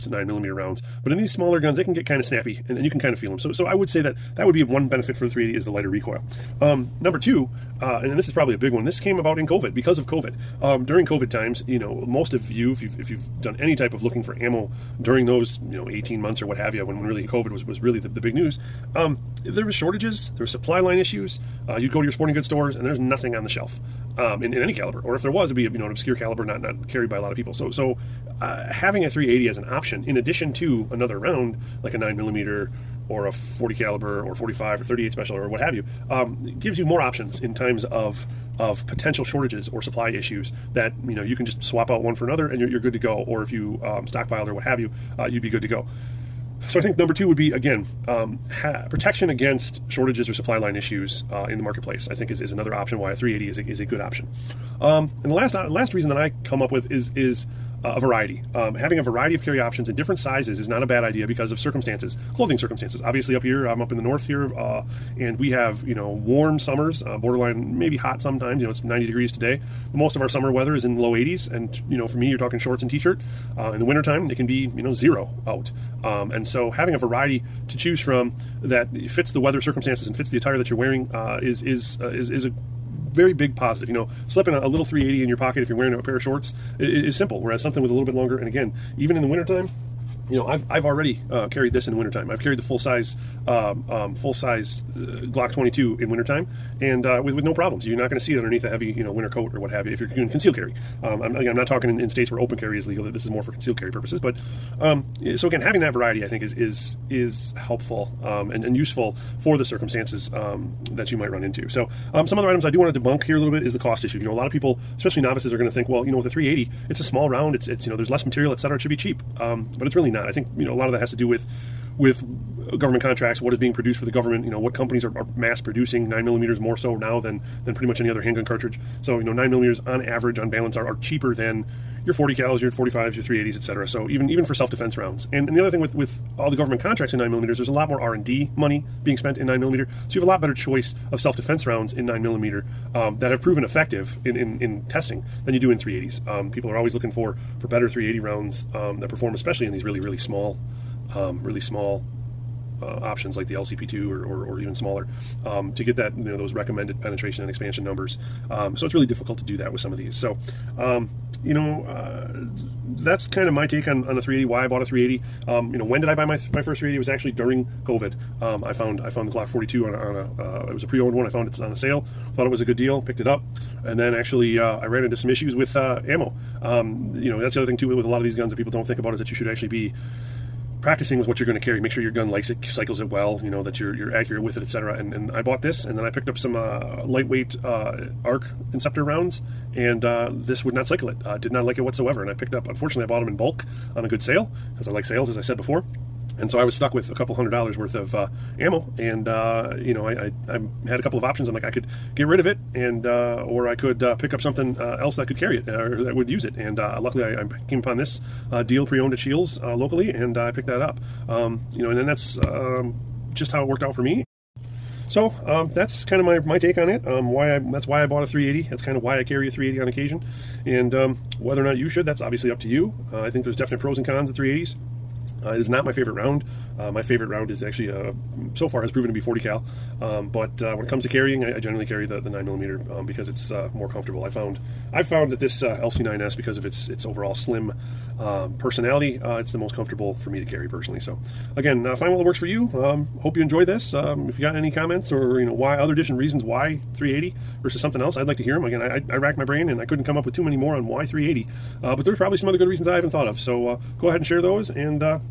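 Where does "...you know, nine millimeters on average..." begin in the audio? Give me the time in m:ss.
2:09.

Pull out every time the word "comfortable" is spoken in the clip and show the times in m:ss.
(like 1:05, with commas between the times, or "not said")
3:53, 3:59.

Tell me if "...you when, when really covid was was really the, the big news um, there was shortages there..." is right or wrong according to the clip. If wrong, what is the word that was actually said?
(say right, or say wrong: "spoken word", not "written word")
right.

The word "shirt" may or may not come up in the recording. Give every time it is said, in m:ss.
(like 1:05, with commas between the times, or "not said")
1:12.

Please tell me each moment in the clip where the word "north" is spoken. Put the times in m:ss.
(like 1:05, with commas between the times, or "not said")
1:04.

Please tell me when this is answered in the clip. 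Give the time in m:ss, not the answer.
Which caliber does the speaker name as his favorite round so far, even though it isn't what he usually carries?
3:49.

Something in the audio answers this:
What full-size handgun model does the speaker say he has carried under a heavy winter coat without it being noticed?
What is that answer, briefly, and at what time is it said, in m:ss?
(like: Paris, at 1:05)
Glock 22, at 1:35.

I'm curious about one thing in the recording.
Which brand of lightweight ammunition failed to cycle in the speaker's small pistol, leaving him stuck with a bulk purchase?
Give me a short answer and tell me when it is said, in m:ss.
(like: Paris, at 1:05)
ARX inceptor, at 3:08.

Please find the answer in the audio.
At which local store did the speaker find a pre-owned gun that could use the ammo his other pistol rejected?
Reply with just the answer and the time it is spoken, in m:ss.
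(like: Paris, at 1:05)
Shields, at 3:29.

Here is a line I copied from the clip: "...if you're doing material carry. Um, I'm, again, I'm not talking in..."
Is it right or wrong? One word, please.
wrong.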